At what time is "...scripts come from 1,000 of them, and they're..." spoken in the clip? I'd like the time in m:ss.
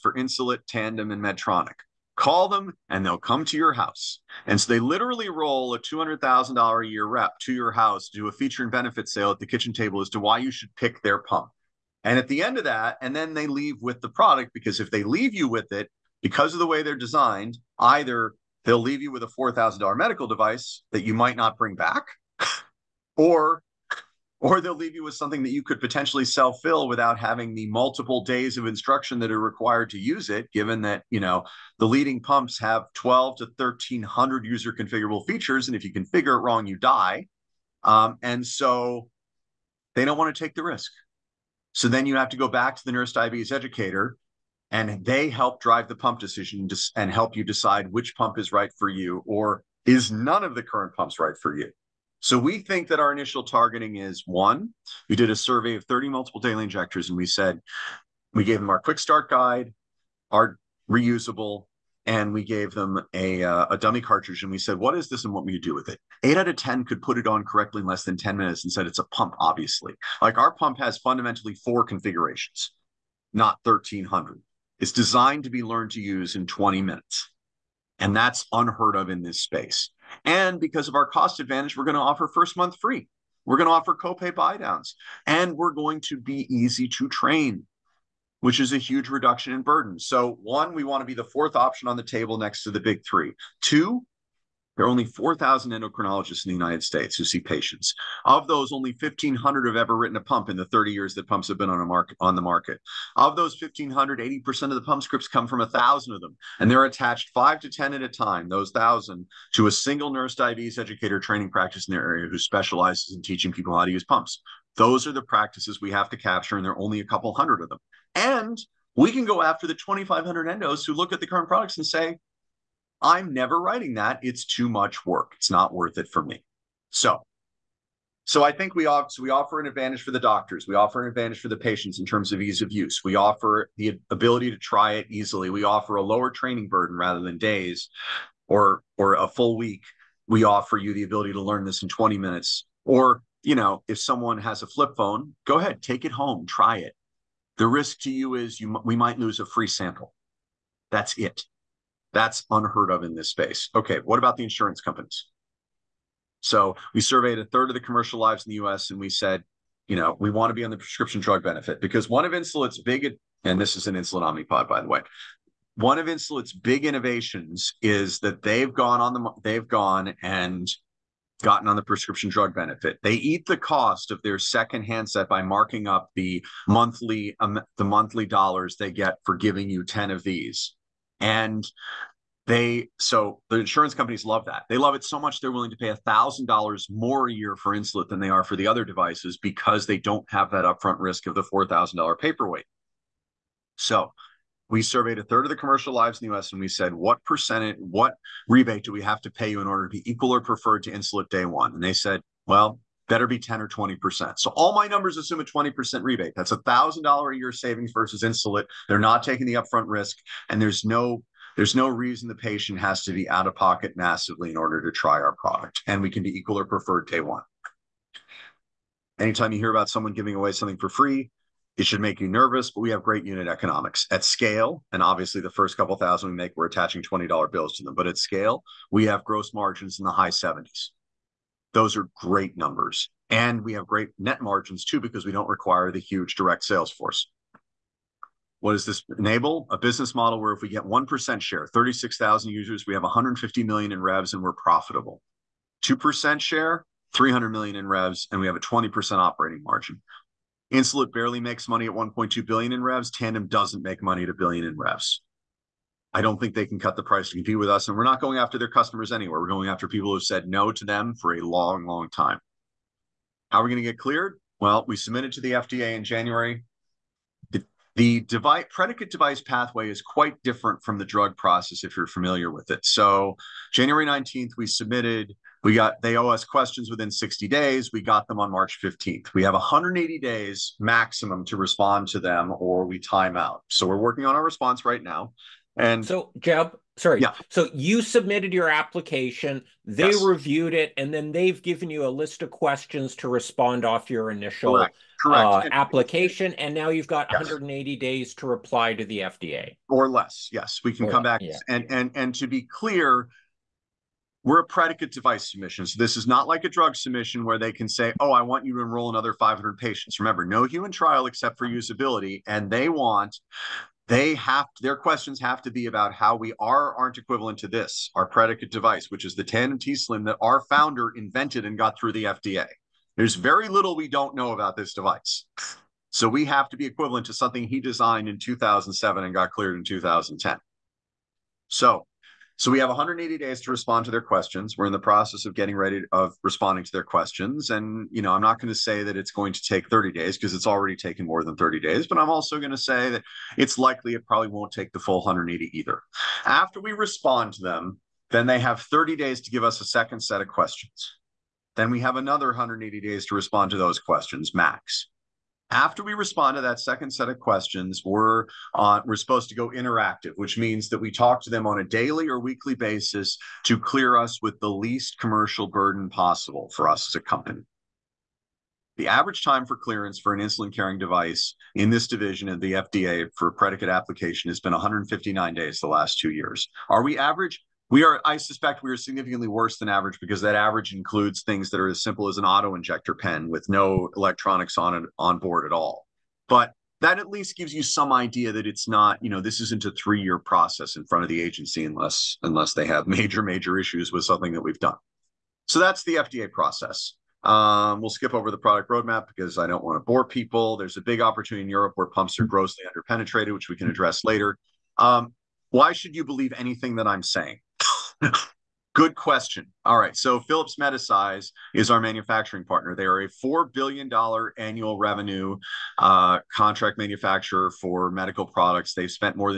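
1:45.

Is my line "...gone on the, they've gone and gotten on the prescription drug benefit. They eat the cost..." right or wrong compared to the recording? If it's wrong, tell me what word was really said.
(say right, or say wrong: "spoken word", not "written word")
right.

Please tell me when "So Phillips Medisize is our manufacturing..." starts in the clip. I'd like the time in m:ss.
6:50.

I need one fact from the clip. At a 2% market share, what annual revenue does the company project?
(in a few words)
300 million.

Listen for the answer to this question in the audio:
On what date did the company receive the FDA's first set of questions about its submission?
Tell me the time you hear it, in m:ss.
4:38.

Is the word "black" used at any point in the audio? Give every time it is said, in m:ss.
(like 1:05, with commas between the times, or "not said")
not said.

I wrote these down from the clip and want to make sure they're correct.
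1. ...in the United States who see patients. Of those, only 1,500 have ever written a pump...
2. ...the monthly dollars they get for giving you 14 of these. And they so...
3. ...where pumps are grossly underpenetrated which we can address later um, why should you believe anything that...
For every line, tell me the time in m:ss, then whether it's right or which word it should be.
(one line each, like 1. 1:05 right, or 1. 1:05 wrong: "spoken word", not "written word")
1. 1:36 right
2. 2:57 wrong: "10", not "14"
3. 6:41 right.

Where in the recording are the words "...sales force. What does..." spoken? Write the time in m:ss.
3:56.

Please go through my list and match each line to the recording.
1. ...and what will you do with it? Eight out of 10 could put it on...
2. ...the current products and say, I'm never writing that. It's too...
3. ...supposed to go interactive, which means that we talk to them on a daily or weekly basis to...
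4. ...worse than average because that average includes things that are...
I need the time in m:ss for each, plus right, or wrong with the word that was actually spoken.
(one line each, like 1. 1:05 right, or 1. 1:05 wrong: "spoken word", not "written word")
1. 1:05 right
2. 2:01 right
3. 5:59 right
4. 6:19 right.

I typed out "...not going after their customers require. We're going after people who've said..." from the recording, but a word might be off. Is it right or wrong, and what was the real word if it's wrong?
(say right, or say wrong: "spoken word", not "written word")
wrong: "anywhere", not "require".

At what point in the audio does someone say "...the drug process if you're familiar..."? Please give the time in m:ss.
4:30.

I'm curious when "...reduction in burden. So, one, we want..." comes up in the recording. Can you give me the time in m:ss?
1:29.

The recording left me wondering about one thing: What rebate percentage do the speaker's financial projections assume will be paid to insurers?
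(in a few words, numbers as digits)
20%.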